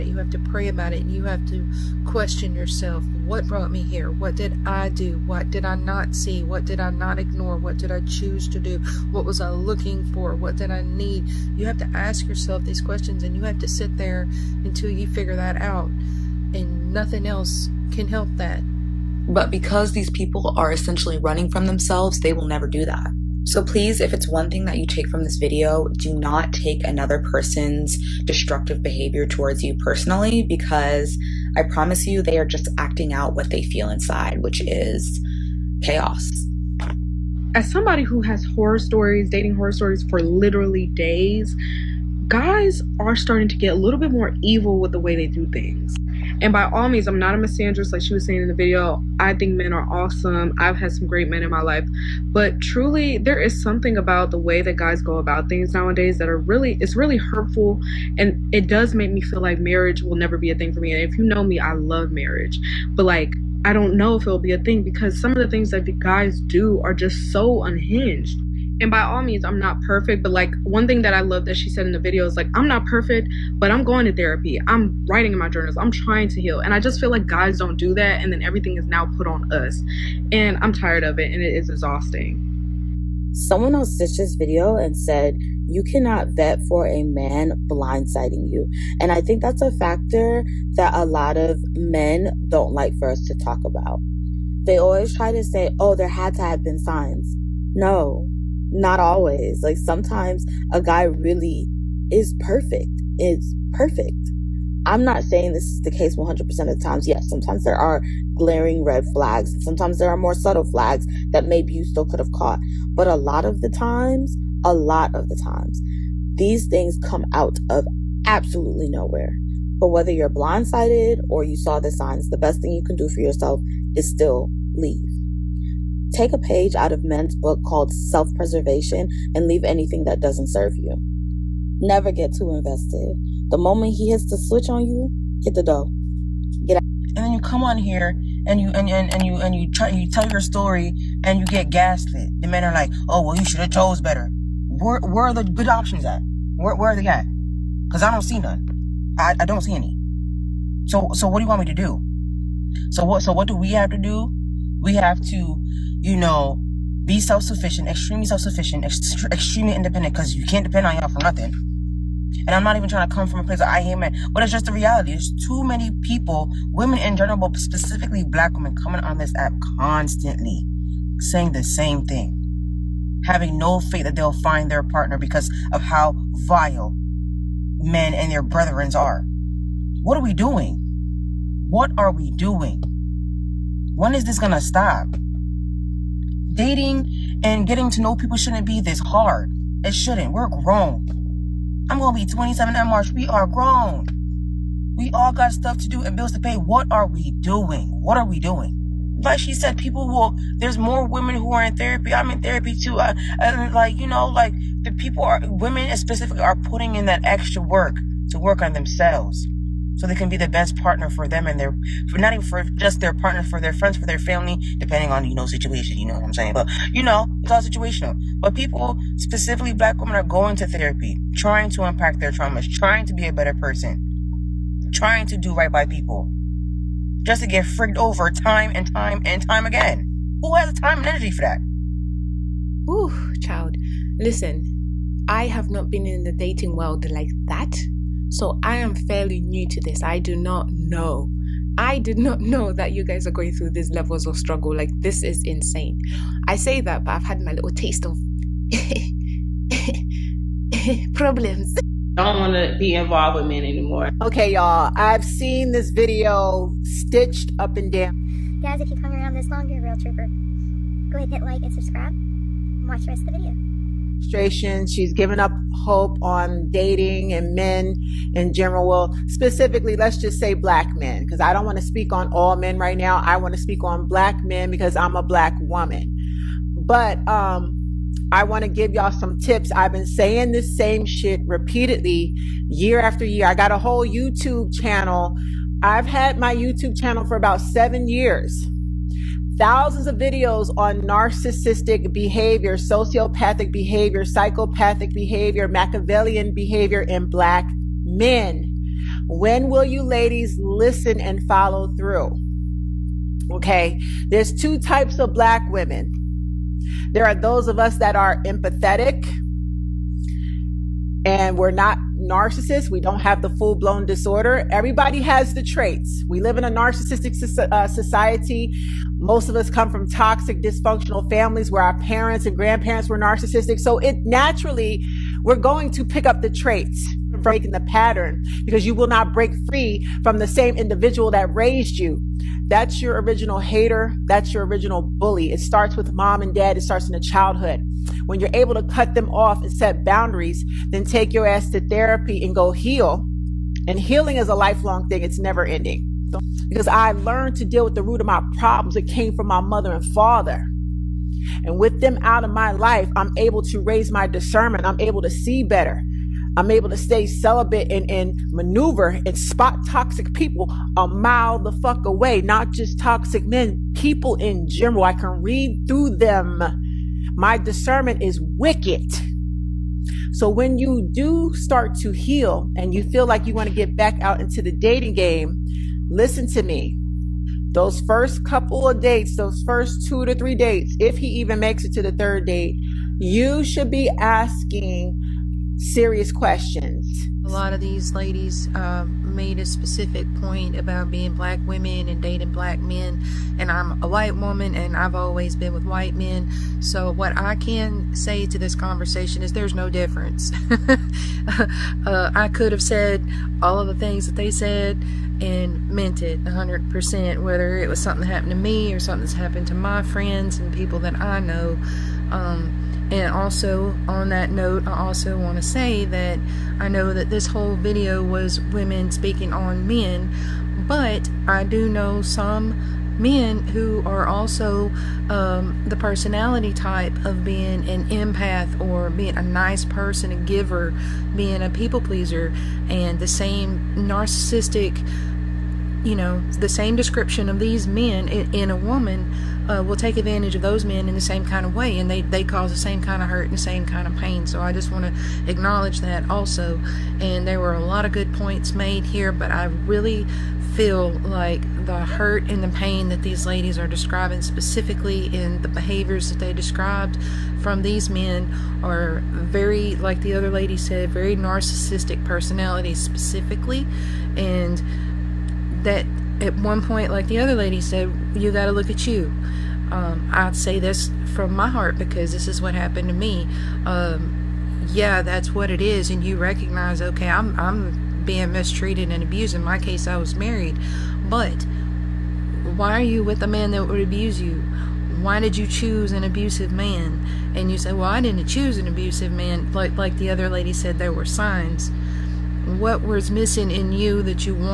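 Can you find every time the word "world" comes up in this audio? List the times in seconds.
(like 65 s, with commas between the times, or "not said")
236 s.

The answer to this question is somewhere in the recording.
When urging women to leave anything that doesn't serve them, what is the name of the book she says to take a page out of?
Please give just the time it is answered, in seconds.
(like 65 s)
127 s.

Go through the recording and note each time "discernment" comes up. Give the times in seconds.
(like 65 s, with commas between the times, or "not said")
354 s, 367 s.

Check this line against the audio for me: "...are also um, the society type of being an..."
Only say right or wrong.
wrong.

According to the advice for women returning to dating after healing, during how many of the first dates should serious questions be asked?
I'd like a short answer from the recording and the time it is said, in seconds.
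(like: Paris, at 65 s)
2 to 3, at 380 s.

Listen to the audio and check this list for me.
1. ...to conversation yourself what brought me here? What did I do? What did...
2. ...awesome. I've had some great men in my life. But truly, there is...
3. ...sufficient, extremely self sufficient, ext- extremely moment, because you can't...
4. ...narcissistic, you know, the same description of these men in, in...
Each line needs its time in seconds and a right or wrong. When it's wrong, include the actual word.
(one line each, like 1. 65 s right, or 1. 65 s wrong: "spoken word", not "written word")
1. 1 s wrong: "question", not "conversation"
2. 49 s right
3. 157 s wrong: "independent", not "moment"
4. 433 s right.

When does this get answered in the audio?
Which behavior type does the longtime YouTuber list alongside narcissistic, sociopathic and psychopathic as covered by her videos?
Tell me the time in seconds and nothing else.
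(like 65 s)
295 s.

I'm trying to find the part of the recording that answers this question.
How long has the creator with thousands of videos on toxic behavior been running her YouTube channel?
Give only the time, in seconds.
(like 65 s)
287 s.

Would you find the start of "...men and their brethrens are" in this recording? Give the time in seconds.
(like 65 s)
177 s.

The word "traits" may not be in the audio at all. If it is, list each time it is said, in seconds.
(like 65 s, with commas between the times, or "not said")
315 s, 326 s.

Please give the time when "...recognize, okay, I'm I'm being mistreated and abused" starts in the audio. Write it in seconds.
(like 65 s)
476 s.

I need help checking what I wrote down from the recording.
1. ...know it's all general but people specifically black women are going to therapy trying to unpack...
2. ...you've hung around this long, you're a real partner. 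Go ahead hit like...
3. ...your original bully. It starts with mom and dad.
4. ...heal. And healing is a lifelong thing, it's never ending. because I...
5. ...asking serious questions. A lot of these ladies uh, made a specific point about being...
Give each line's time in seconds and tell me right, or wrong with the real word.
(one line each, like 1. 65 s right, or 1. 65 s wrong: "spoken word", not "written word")
1. 217 s wrong: "situational", not "general"
2. 258 s wrong: "trooper", not "partner"
3. 334 s right
4. 342 s right
5. 384 s right.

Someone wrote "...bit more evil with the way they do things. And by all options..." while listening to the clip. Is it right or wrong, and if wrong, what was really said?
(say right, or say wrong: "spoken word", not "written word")
wrong: "means", not "options".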